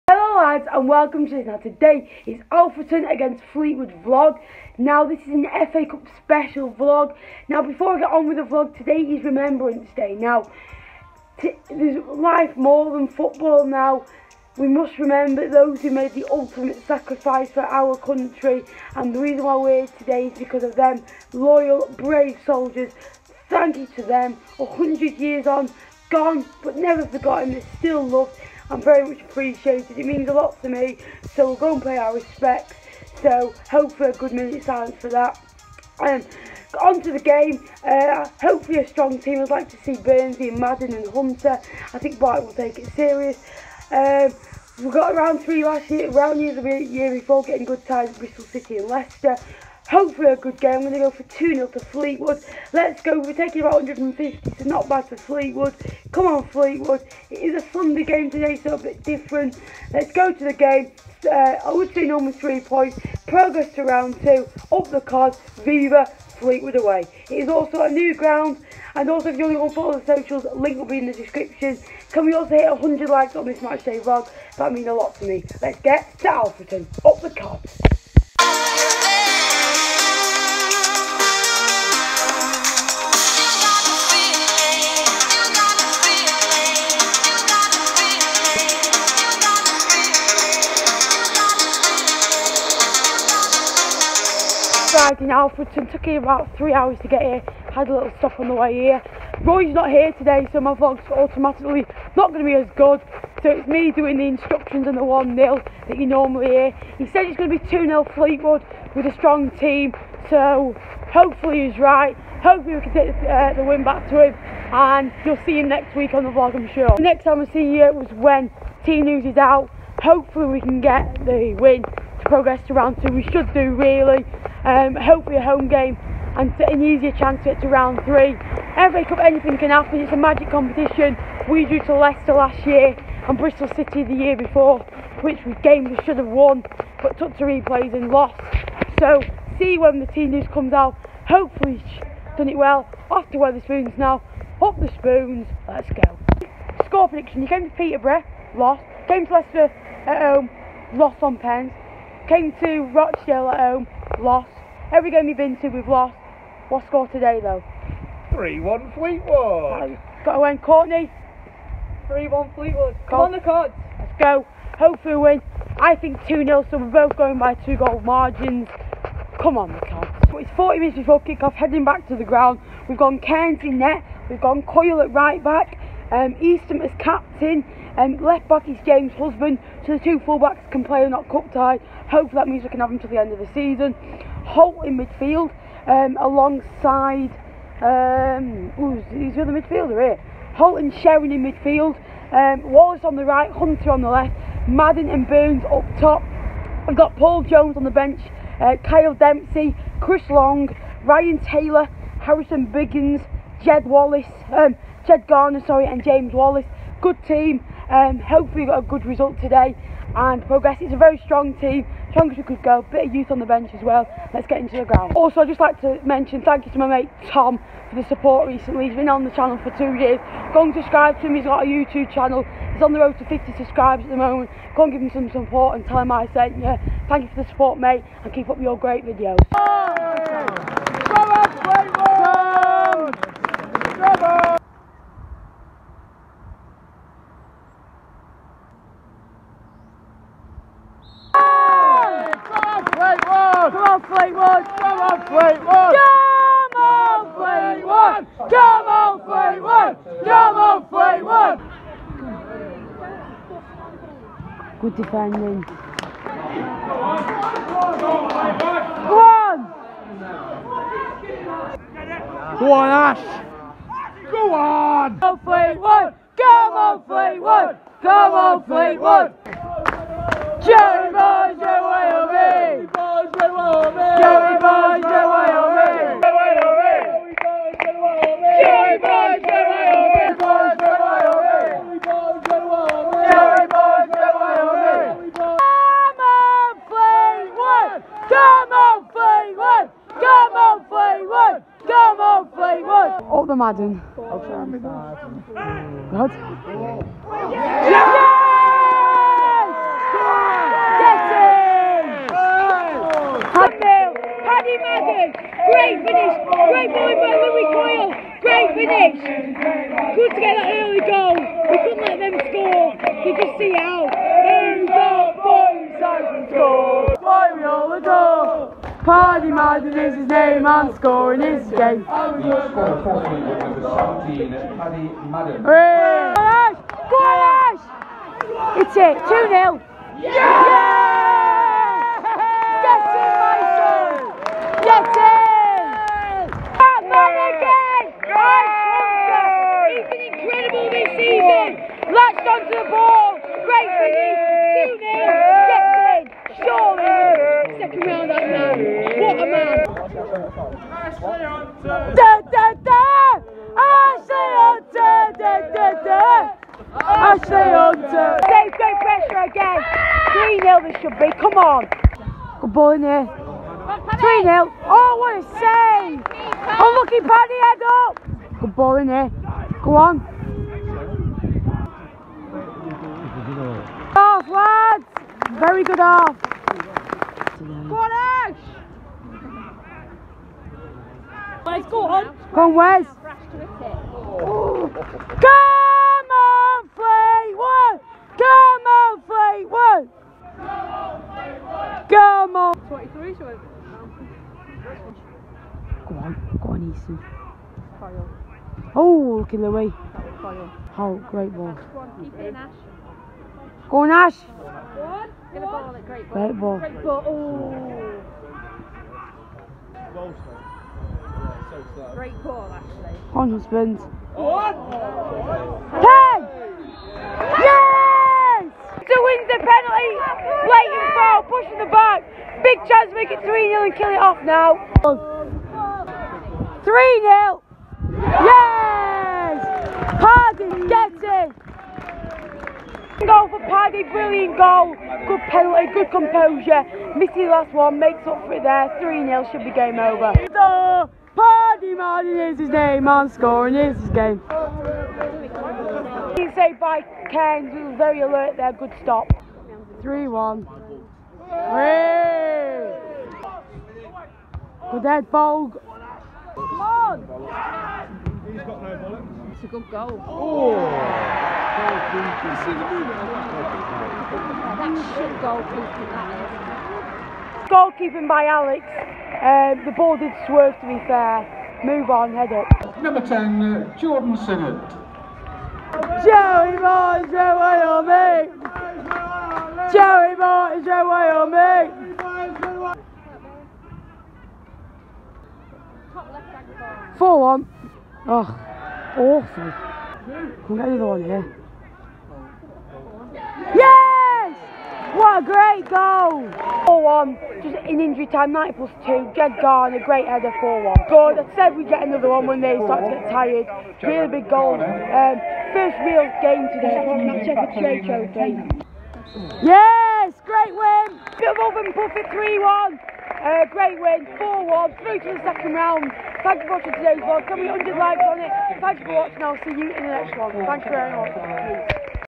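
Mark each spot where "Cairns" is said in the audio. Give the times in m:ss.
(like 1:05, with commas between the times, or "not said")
2:53, 7:27.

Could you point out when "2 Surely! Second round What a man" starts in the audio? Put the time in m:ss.
5:46.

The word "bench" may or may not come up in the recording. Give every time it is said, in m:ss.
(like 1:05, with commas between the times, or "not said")
3:17, 3:33.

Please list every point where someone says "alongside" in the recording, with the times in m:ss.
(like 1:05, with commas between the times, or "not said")
3:06.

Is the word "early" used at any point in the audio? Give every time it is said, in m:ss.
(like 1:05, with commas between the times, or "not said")
5:10.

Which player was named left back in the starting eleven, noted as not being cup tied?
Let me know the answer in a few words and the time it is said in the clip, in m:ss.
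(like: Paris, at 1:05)
James Husband, at 2:58.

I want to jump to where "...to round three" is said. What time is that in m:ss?
2:07.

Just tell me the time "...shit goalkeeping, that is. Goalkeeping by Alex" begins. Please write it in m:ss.
7:45.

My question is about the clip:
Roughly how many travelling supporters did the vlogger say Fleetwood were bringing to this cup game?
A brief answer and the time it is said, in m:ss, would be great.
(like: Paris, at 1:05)
150, at 0:53.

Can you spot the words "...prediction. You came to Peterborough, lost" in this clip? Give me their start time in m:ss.
2:27.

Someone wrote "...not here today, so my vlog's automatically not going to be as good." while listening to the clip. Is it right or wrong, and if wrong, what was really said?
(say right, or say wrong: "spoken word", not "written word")
right.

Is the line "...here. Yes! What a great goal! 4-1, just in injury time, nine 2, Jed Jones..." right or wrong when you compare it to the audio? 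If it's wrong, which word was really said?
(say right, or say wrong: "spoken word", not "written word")
wrong: "Garner", not "Jones".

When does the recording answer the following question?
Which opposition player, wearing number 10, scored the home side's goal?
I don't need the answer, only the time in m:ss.
7:53.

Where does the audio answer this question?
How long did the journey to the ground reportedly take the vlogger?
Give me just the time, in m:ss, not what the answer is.
1:36.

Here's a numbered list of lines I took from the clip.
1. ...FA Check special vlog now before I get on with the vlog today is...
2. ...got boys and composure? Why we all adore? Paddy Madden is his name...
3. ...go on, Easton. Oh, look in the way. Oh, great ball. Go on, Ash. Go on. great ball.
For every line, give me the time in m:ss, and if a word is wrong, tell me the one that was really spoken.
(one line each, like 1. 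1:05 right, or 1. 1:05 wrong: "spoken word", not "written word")
1. 0:05 wrong: "Cup", not "Check"
2. 5:14 wrong: "score", not "composure"
3. 6:36 right.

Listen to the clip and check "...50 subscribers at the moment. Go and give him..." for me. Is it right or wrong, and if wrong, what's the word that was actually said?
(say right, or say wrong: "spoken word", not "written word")
right.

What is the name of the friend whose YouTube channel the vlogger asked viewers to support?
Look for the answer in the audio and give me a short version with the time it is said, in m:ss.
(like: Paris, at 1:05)
Tom, at 3:37.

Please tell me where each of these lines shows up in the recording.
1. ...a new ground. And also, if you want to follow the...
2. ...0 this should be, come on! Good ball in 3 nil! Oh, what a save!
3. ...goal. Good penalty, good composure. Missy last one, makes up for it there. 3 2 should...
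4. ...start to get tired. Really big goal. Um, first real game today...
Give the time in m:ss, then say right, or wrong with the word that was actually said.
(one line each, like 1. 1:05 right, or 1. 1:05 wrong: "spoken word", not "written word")
1. 1:07 right
2. 6:00 right
3. 7:14 wrong: "0", not "2"
4. 8:22 right.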